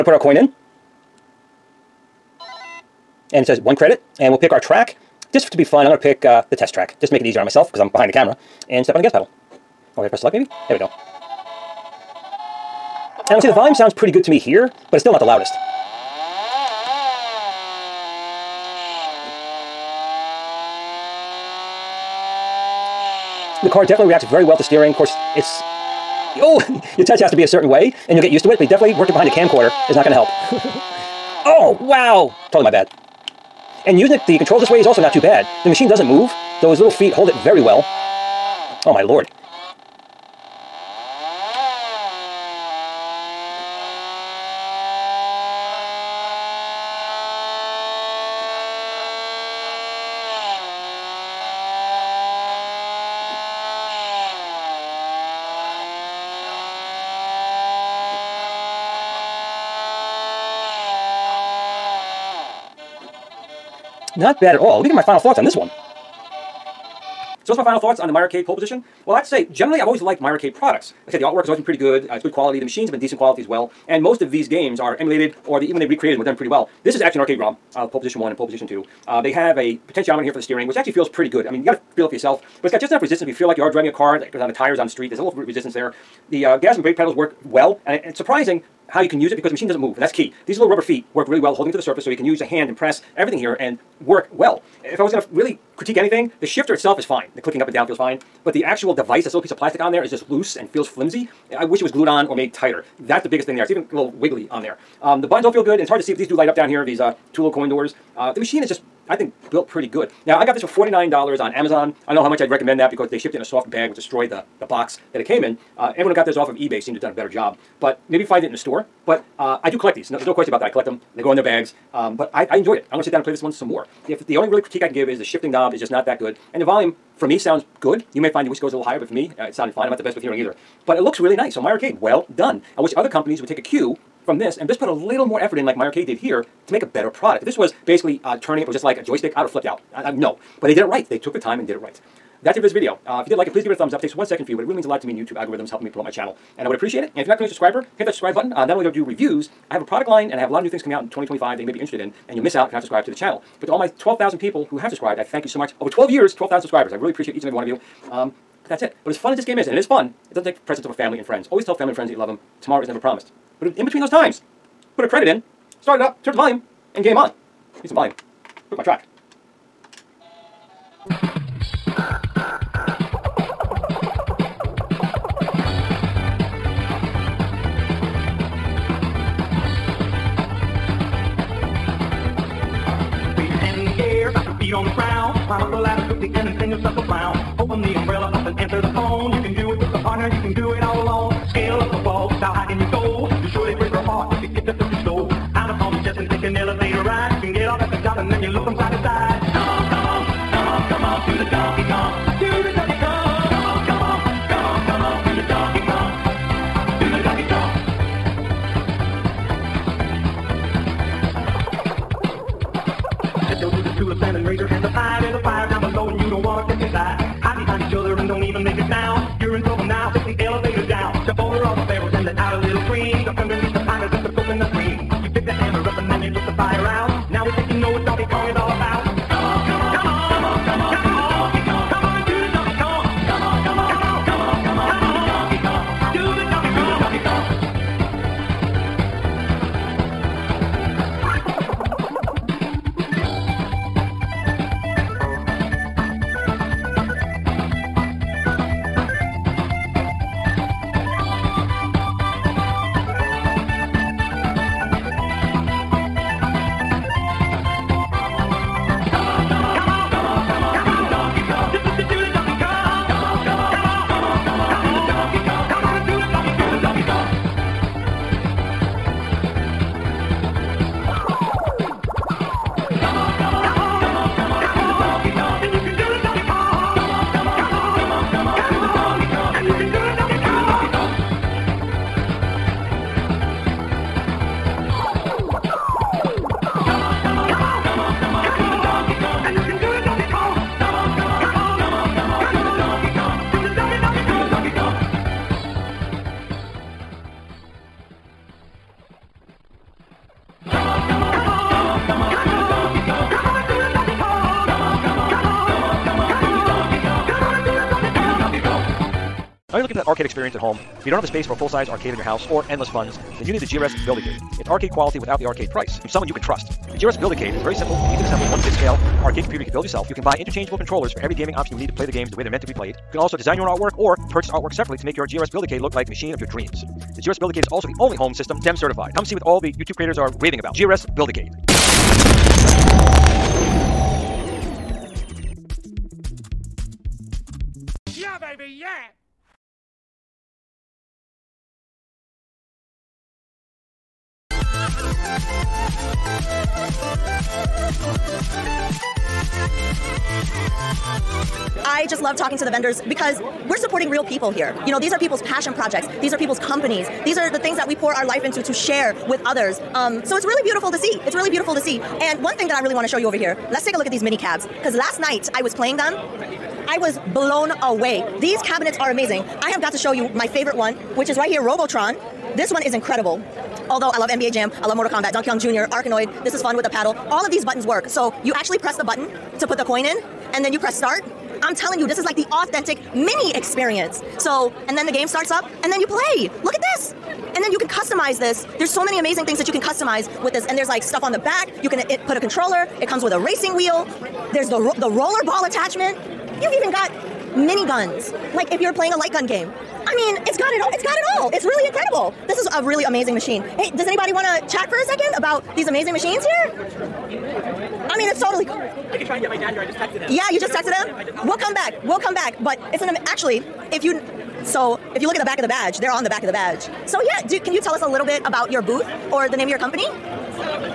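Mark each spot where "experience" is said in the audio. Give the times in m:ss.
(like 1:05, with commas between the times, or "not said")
5:10, 6:23.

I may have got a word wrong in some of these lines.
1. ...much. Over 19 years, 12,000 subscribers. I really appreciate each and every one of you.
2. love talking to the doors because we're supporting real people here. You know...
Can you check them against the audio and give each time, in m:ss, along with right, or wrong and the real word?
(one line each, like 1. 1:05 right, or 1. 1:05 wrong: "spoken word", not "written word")
1. 2:35 wrong: "12", not "19"
2. 5:52 wrong: "vendors", not "doors".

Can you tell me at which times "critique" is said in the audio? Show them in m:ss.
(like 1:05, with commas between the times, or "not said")
1:35, 2:04.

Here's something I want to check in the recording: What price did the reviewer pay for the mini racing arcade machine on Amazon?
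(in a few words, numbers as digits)
$49.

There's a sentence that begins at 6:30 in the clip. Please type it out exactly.
And there's like stuff on the back.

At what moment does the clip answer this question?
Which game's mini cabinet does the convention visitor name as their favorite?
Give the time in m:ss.
6:11.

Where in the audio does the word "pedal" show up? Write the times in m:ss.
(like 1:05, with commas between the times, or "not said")
0:09, 1:26.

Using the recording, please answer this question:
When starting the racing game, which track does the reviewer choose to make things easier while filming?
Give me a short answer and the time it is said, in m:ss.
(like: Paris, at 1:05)
test track, at 0:06.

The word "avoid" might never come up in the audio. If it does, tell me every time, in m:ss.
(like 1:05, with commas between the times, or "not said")
not said.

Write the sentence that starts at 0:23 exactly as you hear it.
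The car definitely reacts very well to steering.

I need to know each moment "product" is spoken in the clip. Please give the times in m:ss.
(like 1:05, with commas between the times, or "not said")
1:10, 2:17, 2:29.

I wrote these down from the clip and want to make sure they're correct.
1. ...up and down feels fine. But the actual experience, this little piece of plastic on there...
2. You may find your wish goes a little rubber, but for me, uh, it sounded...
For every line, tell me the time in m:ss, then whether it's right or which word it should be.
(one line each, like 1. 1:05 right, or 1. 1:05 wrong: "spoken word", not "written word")
1. 1:37 wrong: "device", not "experience"
2. 2:08 wrong: "higher", not "rubber".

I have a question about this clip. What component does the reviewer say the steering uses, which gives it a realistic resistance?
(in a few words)
potentiometer.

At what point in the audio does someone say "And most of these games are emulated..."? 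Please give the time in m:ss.
1:13.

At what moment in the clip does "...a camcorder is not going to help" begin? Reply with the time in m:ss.
0:29.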